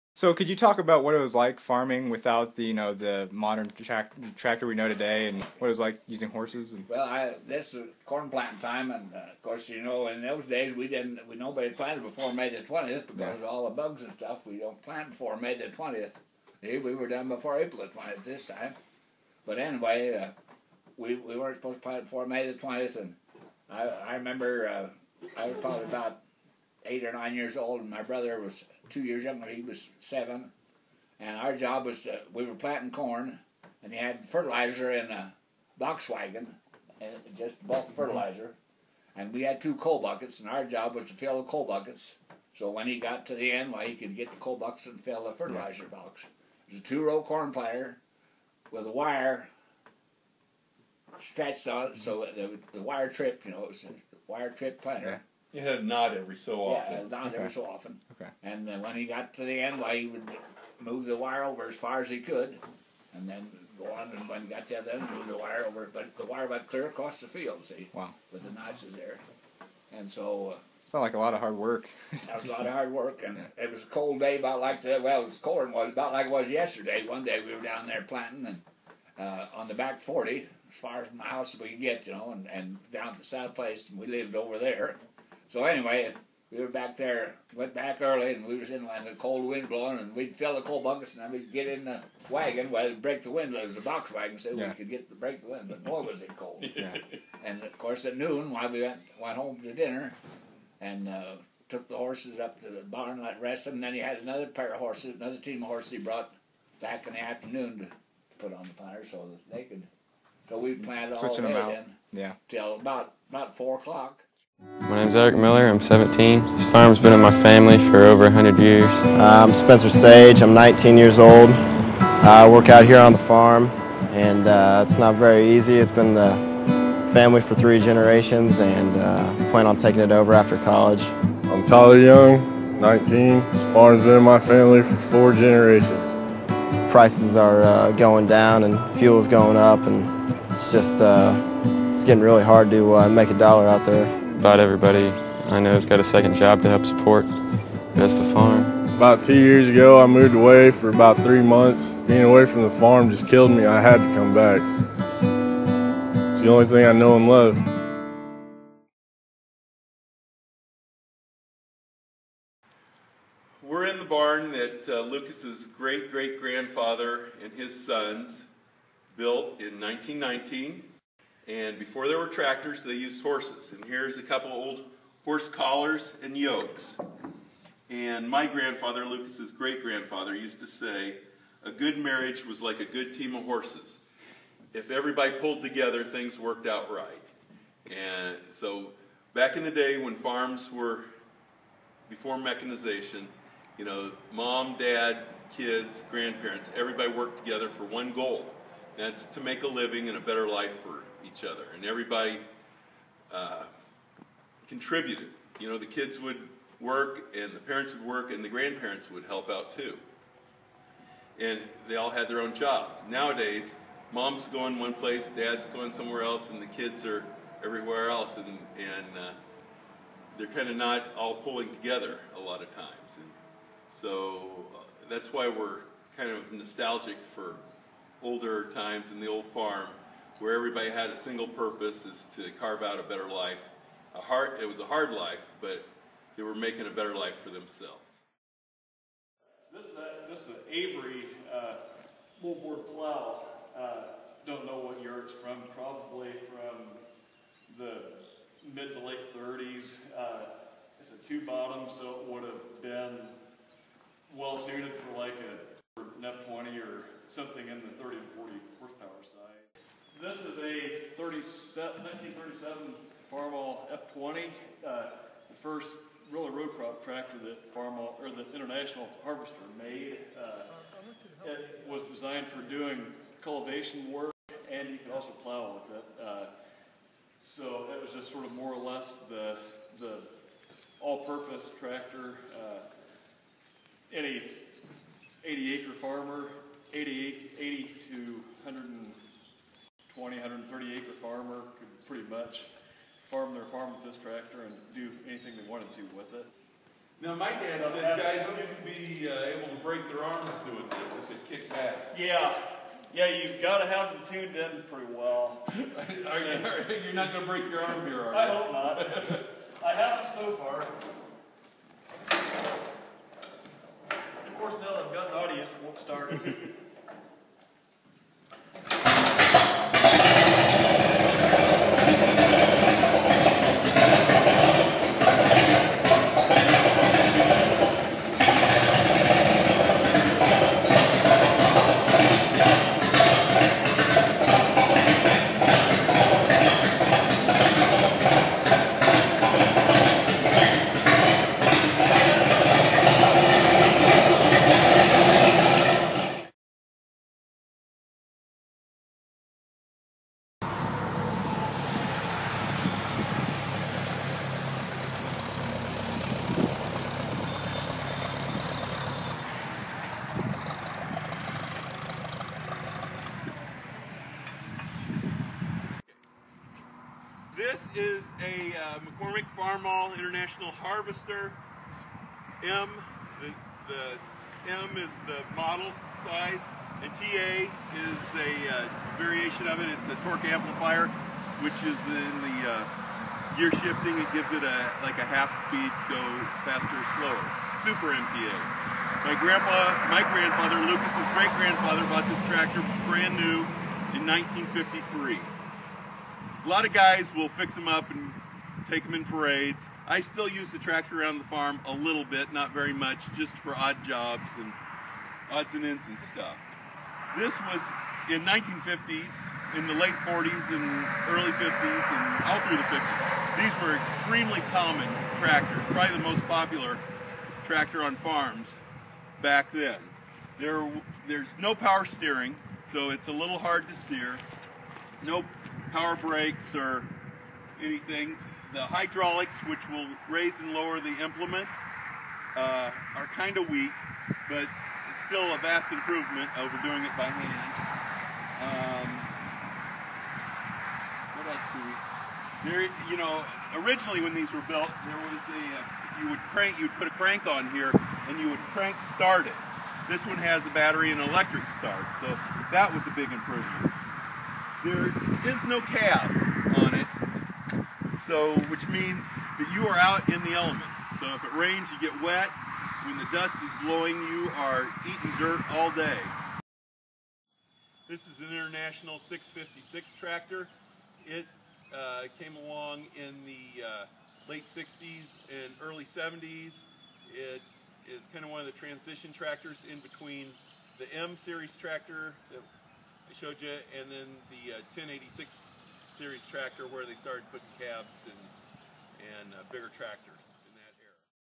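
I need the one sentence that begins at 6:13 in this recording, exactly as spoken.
The, the M is the model size, and TA is a uh, variation of it.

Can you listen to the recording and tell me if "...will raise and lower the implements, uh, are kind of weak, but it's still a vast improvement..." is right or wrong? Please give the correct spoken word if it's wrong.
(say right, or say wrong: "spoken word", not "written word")
right.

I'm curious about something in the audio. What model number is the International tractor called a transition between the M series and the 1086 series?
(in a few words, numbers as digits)
656.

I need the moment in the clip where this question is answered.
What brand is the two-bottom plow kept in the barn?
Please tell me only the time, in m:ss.
4:00.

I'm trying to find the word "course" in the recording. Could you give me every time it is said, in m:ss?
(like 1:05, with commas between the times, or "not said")
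0:09, 1:37, 5:14.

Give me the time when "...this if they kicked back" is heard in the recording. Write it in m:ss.
5:01.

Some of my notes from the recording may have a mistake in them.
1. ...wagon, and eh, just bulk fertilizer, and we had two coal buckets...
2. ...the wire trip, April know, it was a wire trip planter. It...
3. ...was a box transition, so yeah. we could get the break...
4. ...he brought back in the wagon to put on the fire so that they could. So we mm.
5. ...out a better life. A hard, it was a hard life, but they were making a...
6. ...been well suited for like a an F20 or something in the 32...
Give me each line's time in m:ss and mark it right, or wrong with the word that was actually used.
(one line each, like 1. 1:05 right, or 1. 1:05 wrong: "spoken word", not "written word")
1. 0:36 right
2. 0:52 wrong: "You", not "April"
3. 1:33 wrong: "wagon", not "transition"
4. 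1:45 wrong: "afternoon", not "wagon"
5. 3:52 right
6. 4:12 wrong: "30", not "32".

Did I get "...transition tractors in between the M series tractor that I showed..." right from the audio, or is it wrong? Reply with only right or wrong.
right.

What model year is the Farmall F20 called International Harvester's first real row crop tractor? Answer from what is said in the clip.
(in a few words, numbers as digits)
1937.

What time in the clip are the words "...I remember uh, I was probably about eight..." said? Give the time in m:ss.
0:23.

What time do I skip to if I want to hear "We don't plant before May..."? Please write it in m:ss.
0:14.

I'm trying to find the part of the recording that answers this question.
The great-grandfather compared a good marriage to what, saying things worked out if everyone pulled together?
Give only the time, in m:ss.
3:02.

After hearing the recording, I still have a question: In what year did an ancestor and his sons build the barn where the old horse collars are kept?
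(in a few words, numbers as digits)
1919.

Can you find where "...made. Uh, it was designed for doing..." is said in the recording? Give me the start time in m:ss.
4:29.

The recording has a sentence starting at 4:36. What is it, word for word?
Uh, so it was just sort of more or less the the all-purpose tractor.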